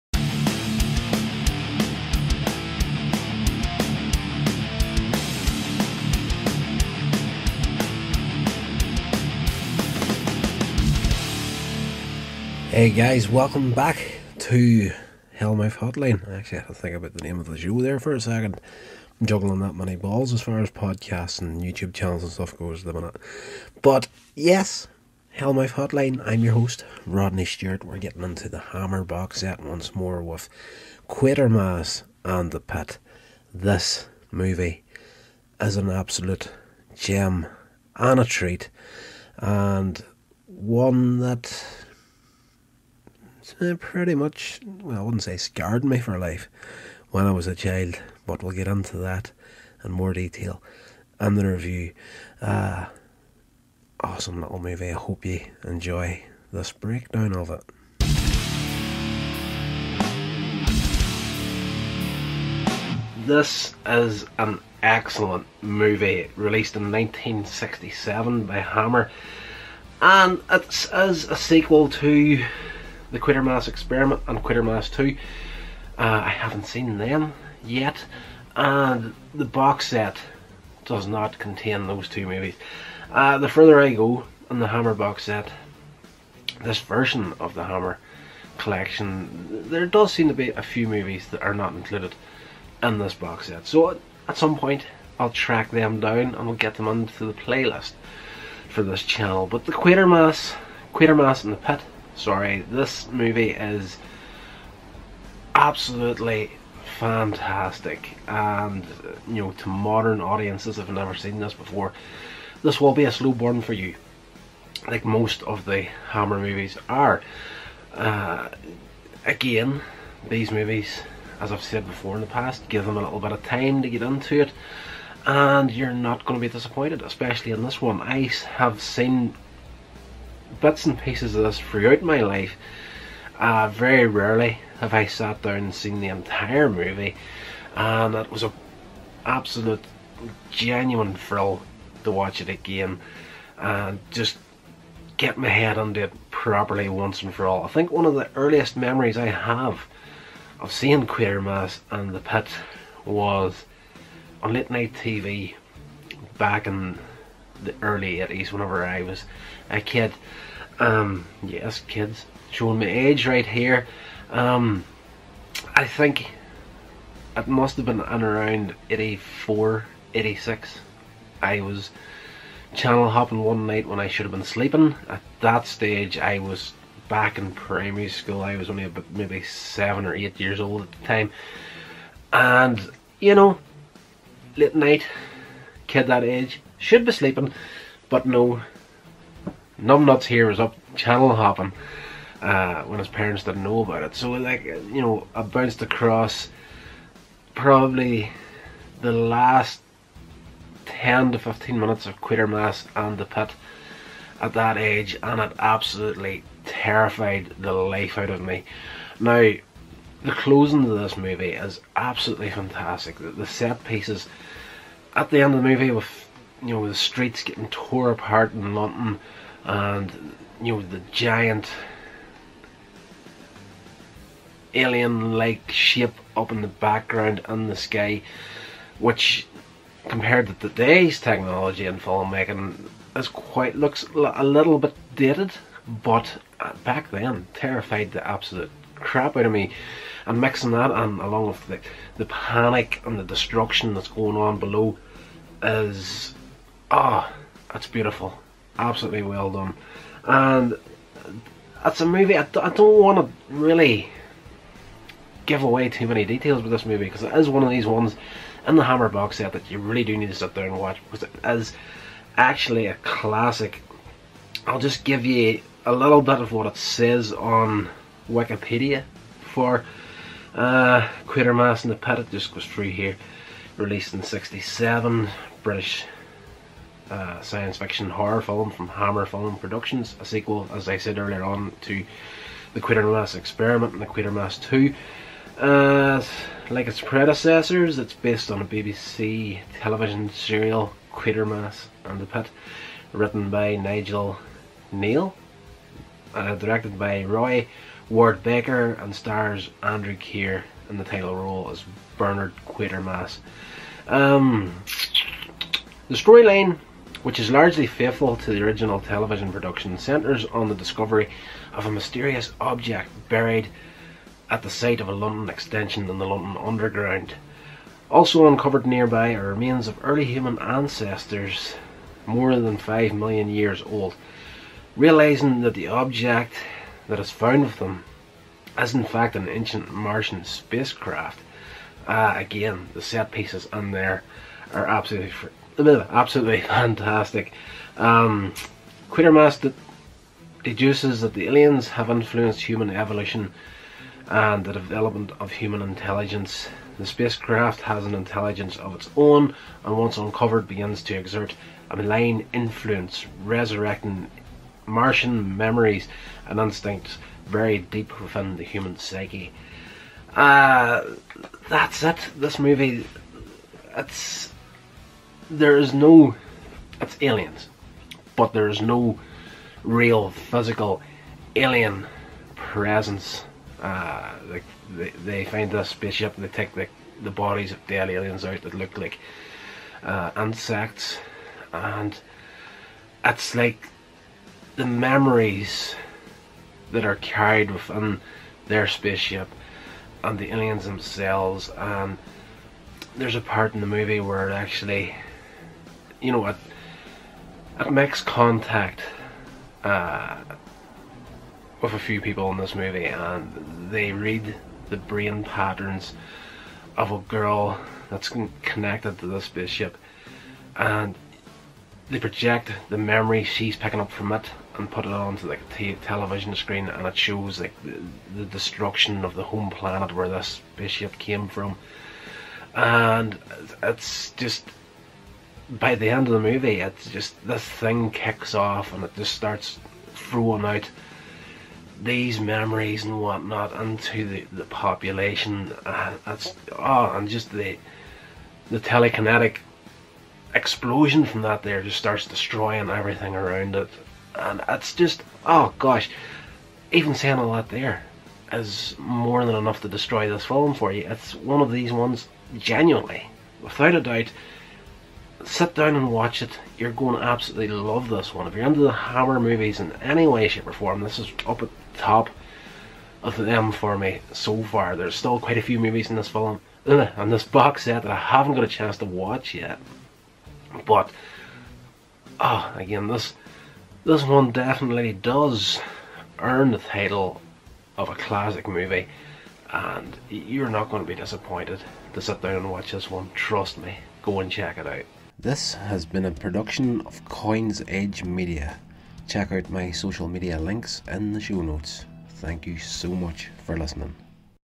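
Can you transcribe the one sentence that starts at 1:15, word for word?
Uh, I haven't seen them yet, and the box set does not contain those two movies.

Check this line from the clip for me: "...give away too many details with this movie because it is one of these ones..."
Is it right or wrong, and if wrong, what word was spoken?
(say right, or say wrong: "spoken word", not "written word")
right.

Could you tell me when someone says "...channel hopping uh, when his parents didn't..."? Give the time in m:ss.
3:10.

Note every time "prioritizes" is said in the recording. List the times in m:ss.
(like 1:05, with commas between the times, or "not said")
not said.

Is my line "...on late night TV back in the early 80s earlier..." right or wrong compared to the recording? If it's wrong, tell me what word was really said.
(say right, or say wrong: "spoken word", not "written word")
wrong: "whenever", not "earlier".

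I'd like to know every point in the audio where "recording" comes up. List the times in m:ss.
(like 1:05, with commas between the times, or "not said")
not said.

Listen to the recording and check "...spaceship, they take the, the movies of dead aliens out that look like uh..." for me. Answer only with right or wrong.
wrong.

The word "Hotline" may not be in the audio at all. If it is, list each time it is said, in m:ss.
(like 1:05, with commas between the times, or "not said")
0:15, 0:25.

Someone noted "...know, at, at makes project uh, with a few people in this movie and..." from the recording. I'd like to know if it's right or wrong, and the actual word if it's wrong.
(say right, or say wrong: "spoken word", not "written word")
wrong: "contact", not "project".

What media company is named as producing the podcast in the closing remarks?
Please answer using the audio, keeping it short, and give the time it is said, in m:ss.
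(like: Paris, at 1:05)
Coins Edge Media, at 8:07.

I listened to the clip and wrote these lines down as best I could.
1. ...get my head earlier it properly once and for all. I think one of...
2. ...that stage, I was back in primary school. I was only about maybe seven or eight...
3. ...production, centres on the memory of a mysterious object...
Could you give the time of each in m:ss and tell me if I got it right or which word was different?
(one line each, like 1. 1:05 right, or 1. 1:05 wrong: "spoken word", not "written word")
1. 2:25 wrong: "under", not "earlier"
2. 2:55 right
3. 5:09 wrong: "discovery", not "memory".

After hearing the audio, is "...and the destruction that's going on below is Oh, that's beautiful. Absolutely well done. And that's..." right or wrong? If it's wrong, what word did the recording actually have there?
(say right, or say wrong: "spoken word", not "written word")
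right.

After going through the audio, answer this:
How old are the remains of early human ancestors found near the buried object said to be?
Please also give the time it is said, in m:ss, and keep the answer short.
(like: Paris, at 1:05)
5 million years, at 5:22.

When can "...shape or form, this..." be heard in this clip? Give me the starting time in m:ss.
7:40.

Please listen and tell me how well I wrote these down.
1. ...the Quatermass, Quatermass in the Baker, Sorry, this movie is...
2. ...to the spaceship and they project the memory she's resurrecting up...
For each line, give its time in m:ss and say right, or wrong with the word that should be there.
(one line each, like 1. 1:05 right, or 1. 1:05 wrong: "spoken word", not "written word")
1. 1:39 wrong: "Pit", not "Baker"
2. 6:49 wrong: "picking", not "resurrecting".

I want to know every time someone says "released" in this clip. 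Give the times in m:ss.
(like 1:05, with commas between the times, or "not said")
1:06, 4:33.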